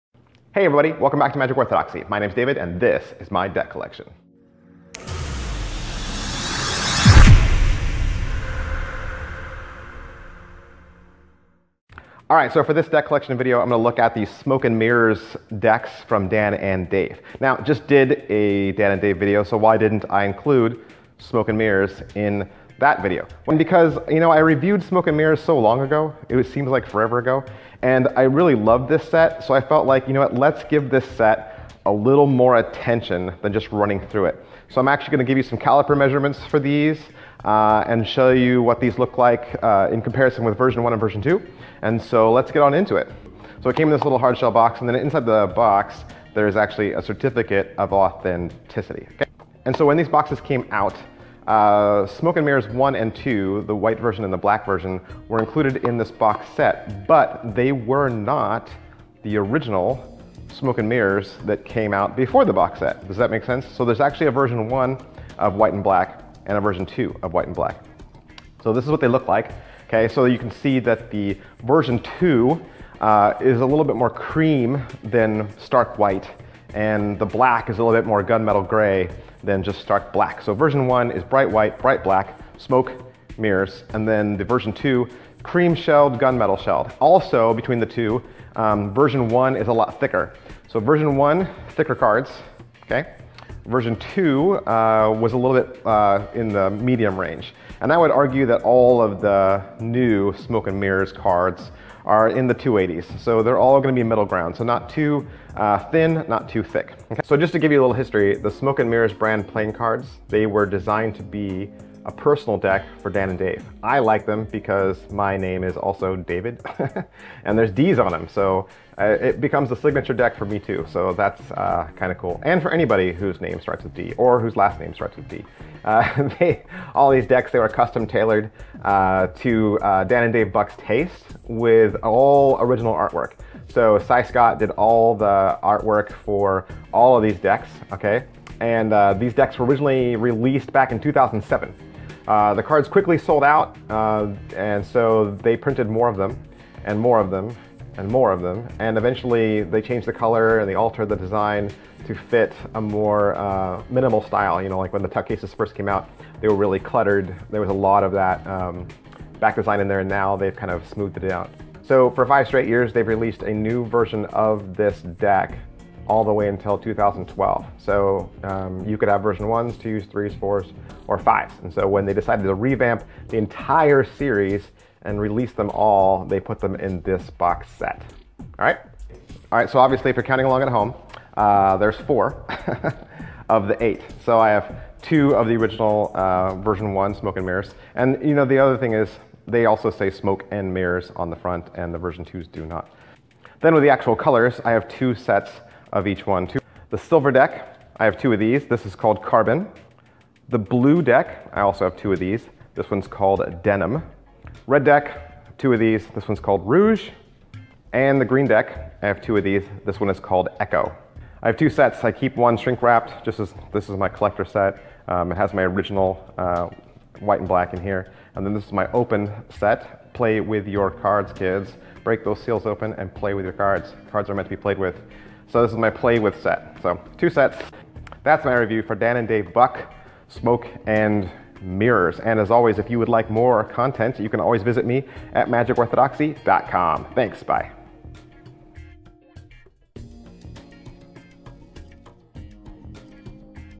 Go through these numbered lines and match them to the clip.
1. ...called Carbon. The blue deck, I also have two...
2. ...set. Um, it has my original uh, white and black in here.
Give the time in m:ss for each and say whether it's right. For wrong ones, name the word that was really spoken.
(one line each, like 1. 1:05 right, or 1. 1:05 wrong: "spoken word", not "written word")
1. 3:18 right
2. 3:34 right.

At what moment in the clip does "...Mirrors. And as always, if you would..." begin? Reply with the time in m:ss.
3:51.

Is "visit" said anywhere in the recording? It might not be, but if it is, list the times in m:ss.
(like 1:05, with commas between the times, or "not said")
3:54.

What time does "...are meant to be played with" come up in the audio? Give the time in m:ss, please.
3:44.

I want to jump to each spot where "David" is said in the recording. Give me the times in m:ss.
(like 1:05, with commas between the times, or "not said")
0:02, 1:56.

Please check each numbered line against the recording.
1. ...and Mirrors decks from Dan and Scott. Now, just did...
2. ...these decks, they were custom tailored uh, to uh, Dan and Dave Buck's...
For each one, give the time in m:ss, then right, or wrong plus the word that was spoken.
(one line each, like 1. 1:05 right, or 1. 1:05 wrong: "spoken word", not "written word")
1. 0:14 wrong: "Dave", not "Scott"
2. 2:07 right.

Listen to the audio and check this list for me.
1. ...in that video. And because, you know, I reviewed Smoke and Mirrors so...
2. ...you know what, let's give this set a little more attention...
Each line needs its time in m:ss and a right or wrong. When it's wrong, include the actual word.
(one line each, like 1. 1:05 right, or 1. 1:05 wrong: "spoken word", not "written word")
1. 0:22 right
2. 0:30 right.